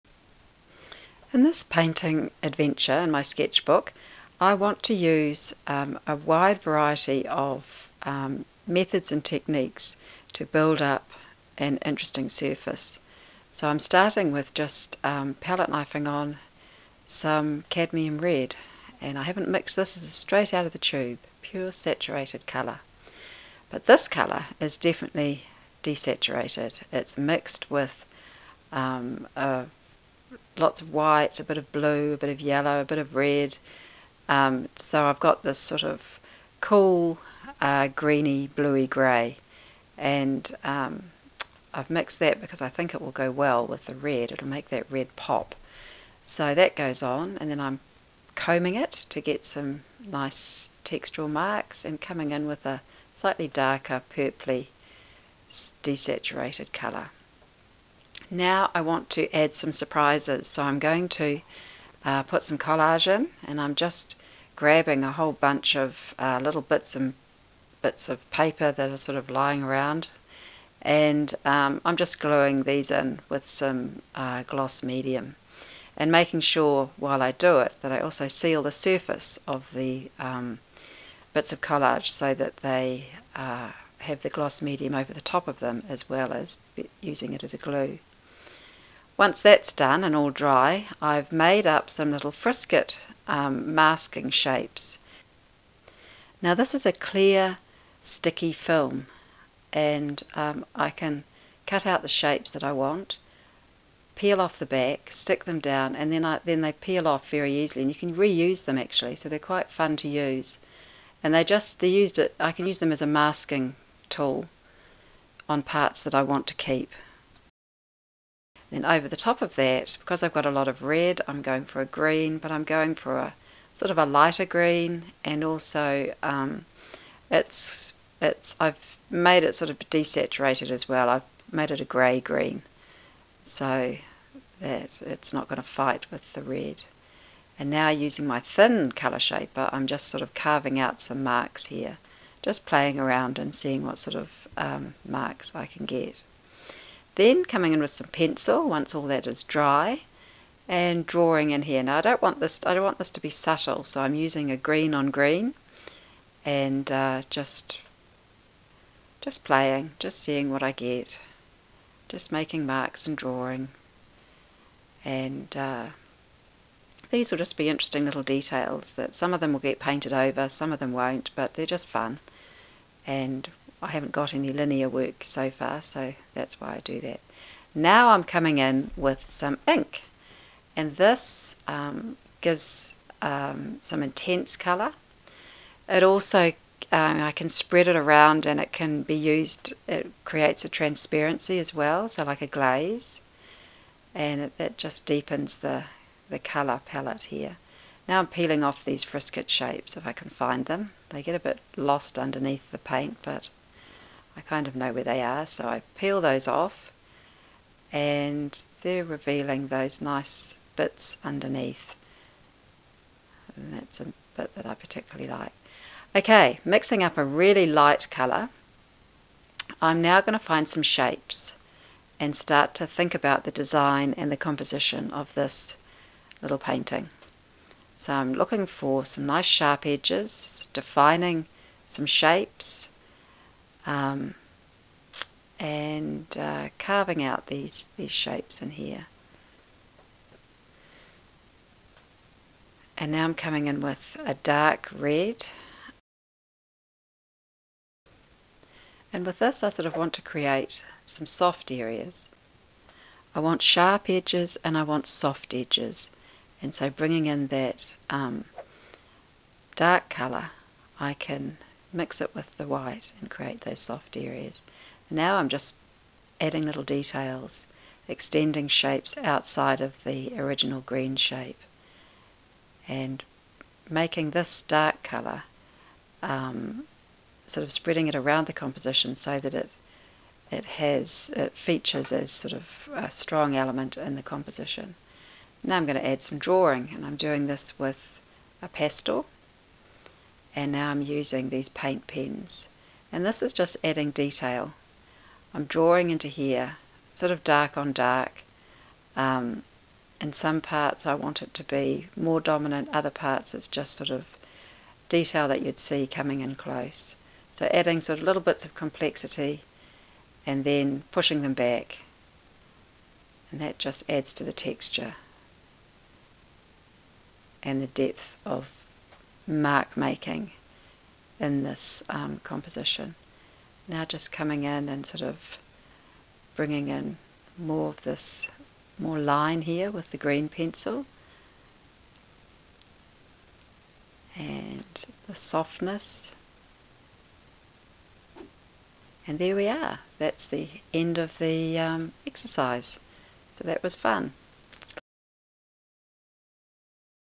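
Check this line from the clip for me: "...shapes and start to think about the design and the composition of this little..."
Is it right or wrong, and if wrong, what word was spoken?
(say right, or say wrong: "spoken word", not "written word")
right.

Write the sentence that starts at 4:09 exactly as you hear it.
And with this I sort of want to create some soft areas.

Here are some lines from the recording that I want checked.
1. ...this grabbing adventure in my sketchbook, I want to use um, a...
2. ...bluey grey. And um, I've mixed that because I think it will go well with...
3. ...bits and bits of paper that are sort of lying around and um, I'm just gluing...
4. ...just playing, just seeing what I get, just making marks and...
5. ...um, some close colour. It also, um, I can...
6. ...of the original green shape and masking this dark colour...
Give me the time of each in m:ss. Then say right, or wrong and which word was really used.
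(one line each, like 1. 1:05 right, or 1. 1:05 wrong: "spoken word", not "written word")
1. 0:01 wrong: "painting", not "grabbing"
2. 0:38 right
3. 1:06 right
4. 2:39 right
5. 3:03 wrong: "intense", not "close"
6. 4:29 wrong: "making", not "masking".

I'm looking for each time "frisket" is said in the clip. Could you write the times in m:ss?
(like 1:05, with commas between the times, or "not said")
1:32, 3:19.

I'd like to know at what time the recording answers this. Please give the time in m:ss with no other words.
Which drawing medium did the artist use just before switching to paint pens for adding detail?
4:48.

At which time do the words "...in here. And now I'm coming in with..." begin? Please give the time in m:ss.
3:58.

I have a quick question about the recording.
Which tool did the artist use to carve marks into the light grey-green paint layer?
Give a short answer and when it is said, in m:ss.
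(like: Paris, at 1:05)
thin colour shaper, at 2:18.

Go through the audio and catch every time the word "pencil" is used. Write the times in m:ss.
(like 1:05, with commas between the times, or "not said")
2:28, 5:30.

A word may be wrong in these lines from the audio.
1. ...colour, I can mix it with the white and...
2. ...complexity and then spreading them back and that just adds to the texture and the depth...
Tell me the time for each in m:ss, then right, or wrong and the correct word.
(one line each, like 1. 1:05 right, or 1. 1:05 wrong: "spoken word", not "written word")
1. 4:20 right
2. 5:08 wrong: "pushing", not "spreading".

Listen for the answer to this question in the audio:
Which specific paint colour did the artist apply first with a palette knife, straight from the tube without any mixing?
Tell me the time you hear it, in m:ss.
0:17.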